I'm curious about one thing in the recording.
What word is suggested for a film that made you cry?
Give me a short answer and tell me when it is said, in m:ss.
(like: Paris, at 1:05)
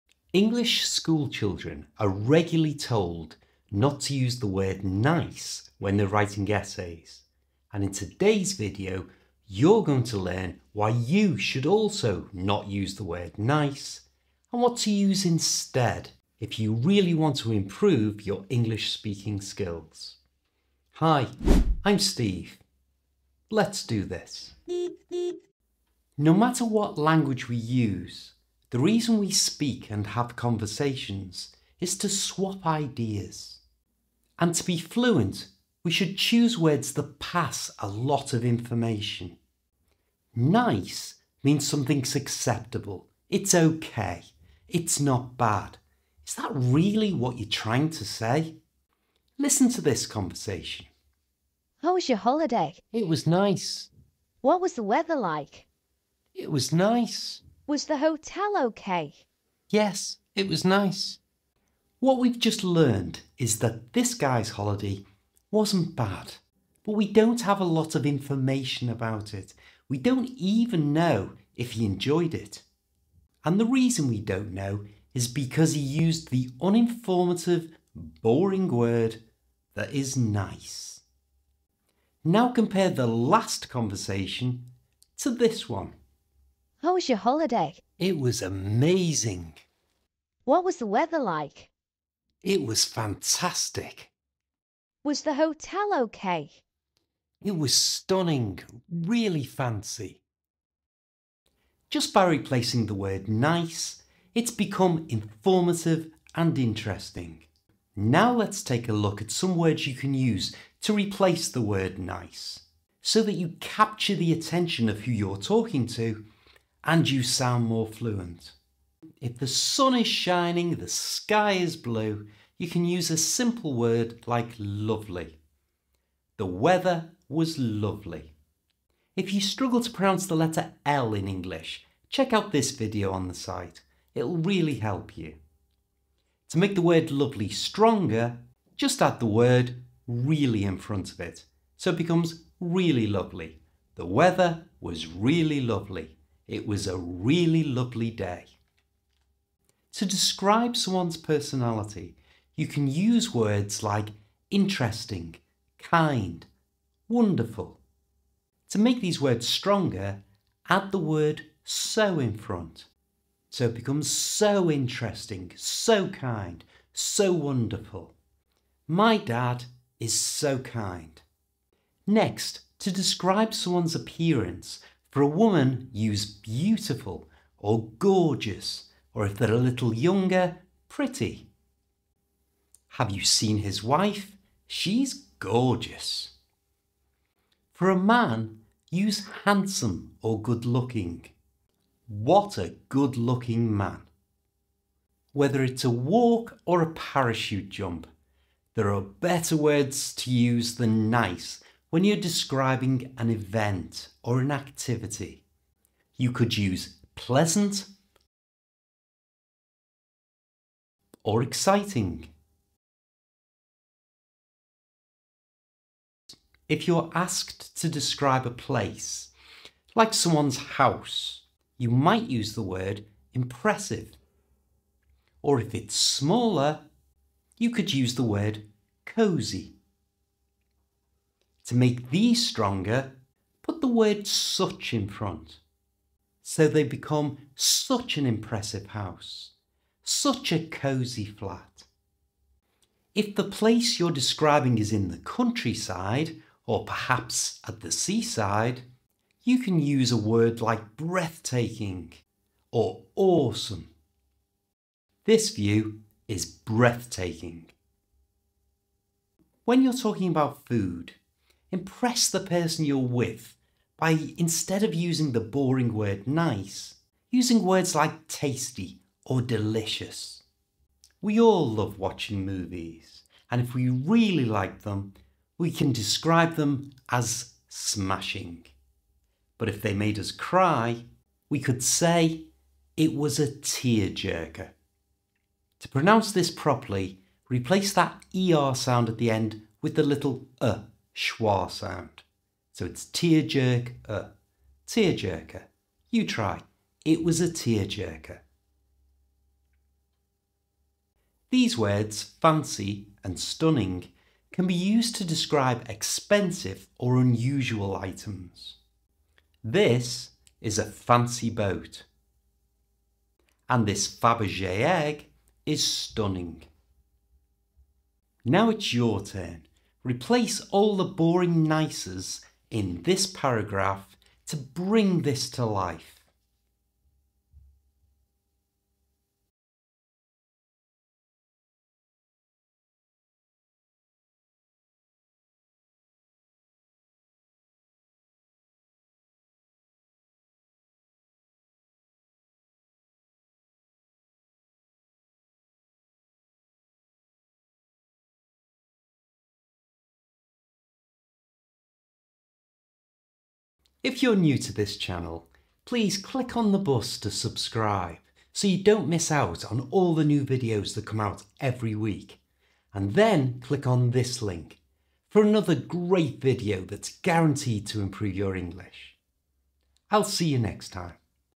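tearjerker, at 4:43.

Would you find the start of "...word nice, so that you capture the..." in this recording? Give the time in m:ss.
1:51.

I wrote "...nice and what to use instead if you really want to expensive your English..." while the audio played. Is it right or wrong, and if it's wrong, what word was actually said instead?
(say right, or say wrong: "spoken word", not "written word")
wrong: "improve", not "expensive".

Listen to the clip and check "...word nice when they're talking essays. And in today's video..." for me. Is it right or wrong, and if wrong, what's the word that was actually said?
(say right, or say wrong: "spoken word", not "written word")
wrong: "writing", not "talking".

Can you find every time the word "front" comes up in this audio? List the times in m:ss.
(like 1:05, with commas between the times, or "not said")
2:20, 2:42, 3:55.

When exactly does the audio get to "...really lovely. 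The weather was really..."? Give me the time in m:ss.
2:22.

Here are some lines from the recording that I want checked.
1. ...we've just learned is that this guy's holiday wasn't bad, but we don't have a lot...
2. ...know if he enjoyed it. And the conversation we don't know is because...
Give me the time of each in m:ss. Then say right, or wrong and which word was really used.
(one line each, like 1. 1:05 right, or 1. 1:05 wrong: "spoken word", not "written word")
1. 1:02 right
2. 1:10 wrong: "reason", not "conversation".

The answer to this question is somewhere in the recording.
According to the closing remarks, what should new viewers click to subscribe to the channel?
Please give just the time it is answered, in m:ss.
5:56.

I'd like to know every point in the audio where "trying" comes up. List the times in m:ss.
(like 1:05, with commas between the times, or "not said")
0:47.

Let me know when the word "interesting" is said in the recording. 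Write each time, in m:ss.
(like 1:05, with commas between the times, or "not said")
1:46, 2:34, 2:44.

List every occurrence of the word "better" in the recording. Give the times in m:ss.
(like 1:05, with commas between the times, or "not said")
3:19.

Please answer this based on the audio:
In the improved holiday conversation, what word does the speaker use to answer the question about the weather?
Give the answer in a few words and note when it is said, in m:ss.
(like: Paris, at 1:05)
fantastic, at 1:32.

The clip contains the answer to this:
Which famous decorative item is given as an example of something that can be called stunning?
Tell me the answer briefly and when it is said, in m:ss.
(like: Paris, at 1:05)
Fabergé egg, at 5:14.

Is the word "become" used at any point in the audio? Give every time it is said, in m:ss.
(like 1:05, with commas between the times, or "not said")
1:44, 2:21, 2:43, 3:56.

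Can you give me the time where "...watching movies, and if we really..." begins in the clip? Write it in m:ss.
4:31.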